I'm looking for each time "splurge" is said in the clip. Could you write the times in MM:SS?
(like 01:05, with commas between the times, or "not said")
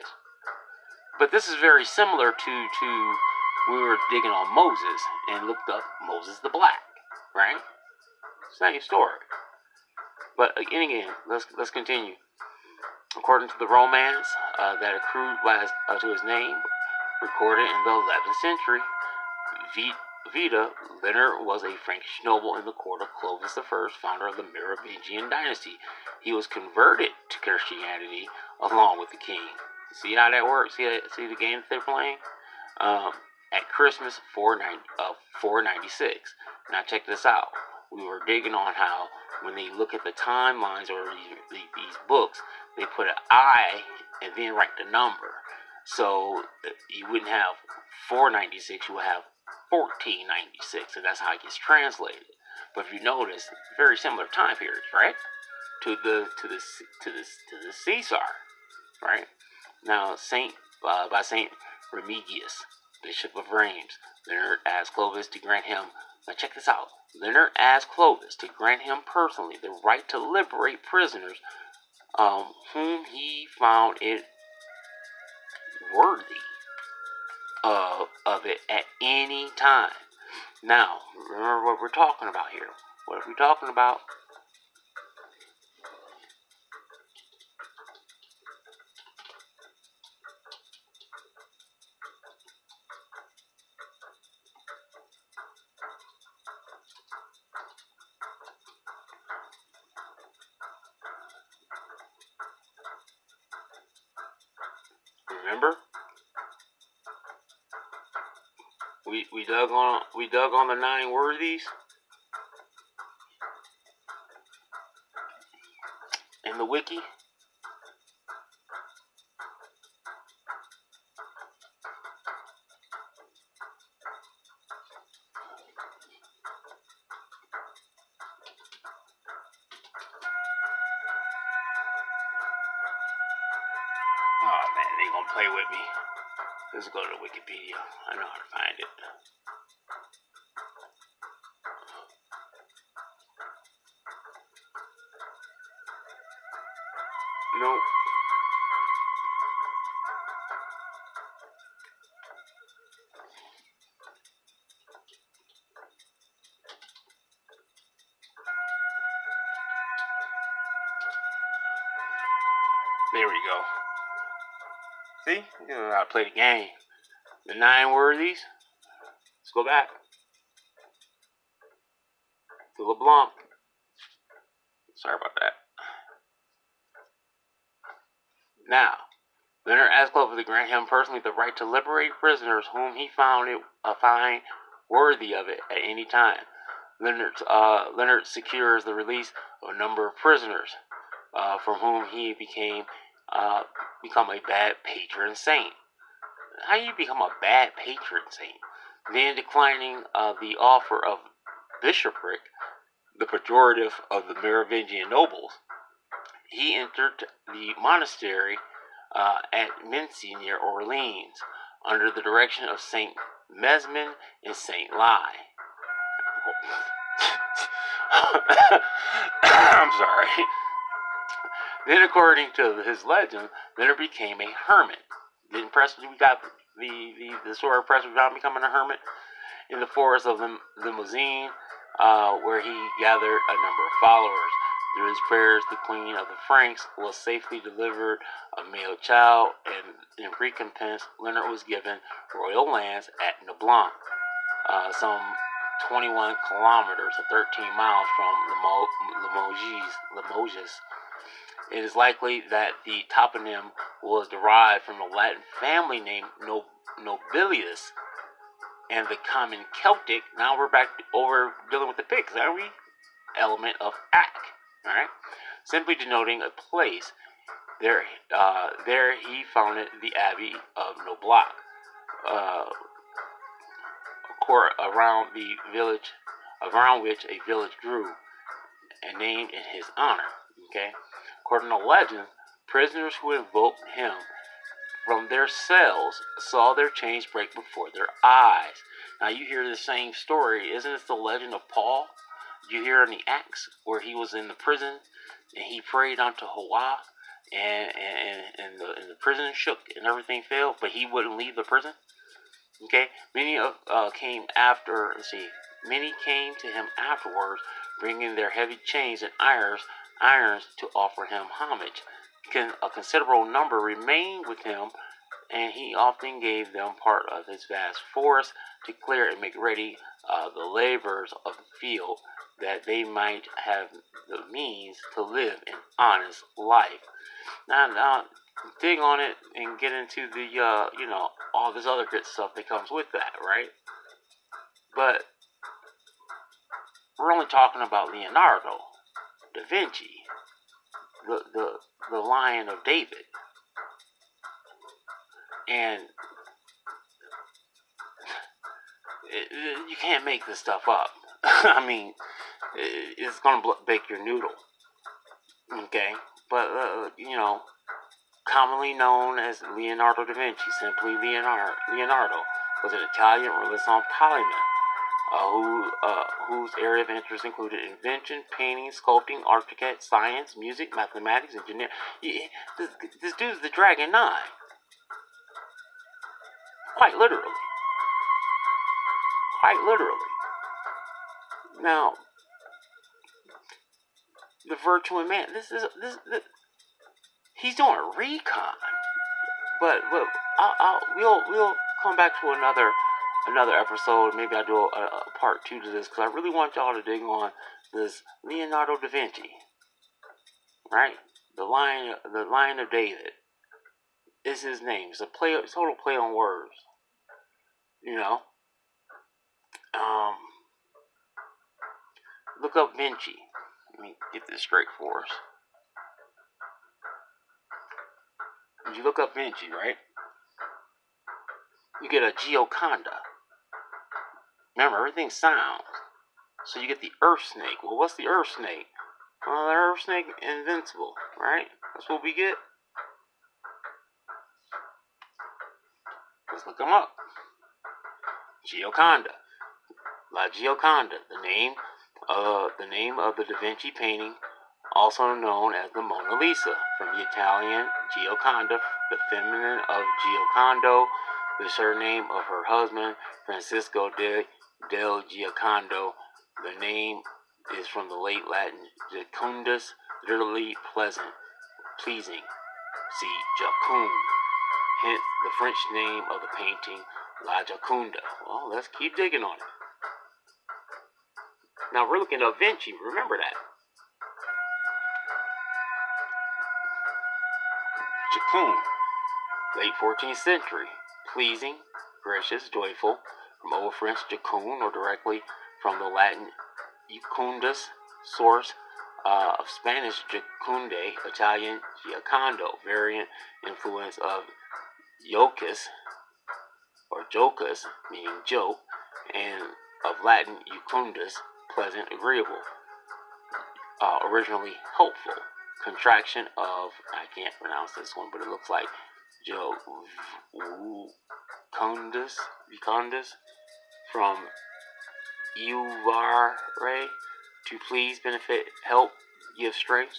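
not said.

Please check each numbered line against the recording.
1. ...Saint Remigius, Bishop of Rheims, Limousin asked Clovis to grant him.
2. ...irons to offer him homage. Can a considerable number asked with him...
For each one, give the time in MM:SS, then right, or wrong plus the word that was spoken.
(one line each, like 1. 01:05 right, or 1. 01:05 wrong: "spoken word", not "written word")
1. 01:01 wrong: "Leonard", not "Limousin"
2. 05:10 wrong: "remained", not "asked".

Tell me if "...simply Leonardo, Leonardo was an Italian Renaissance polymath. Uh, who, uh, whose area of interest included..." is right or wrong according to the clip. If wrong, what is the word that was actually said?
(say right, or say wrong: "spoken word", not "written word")
right.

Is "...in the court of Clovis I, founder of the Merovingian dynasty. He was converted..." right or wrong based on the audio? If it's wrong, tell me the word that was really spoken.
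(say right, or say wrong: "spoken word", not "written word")
right.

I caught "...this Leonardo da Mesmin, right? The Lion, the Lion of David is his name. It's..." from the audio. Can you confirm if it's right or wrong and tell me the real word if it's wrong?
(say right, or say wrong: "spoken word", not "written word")
wrong: "Vinci", not "Mesmin".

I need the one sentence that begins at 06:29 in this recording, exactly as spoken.
But, well, I'll, I'll, we'll we'll come back to another another episode.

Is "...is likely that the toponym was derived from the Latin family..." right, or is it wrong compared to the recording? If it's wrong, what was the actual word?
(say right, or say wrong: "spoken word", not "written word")
right.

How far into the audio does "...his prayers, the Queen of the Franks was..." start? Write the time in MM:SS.
03:55.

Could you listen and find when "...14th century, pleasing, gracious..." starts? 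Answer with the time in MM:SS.
08:00.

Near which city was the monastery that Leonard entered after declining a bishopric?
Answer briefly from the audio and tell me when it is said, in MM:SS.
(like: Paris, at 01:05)
Orleans, at 03:30.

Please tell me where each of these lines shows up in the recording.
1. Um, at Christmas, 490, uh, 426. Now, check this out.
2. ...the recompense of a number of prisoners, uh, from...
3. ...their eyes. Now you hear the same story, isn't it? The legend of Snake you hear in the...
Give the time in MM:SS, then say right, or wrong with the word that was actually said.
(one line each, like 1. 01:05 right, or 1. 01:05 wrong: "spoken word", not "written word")
1. 00:32 wrong: "496", not "426"
2. 03:08 wrong: "release", not "recompense"
3. 04:47 wrong: "Paul", not "Snake".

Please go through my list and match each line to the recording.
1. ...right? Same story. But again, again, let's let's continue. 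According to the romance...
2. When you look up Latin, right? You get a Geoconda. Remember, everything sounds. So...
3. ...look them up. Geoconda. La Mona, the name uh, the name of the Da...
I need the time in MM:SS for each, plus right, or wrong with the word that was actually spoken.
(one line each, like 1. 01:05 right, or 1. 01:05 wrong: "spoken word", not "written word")
1. 00:07 right
2. 06:58 wrong: "Vinci", not "Latin"
3. 07:16 wrong: "Geoconda", not "Mona".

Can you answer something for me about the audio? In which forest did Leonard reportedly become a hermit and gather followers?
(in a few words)
Limousin.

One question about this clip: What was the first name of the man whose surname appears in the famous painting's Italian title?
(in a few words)
Francisco.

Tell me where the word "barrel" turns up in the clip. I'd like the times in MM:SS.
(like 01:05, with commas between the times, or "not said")
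not said.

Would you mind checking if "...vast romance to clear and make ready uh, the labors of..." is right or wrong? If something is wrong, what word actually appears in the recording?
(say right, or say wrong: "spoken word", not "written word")
wrong: "force", not "romance".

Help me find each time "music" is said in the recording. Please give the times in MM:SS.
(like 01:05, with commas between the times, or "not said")
06:10.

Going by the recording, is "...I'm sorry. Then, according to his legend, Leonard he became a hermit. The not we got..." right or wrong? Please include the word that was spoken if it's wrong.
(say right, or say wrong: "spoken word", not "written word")
right.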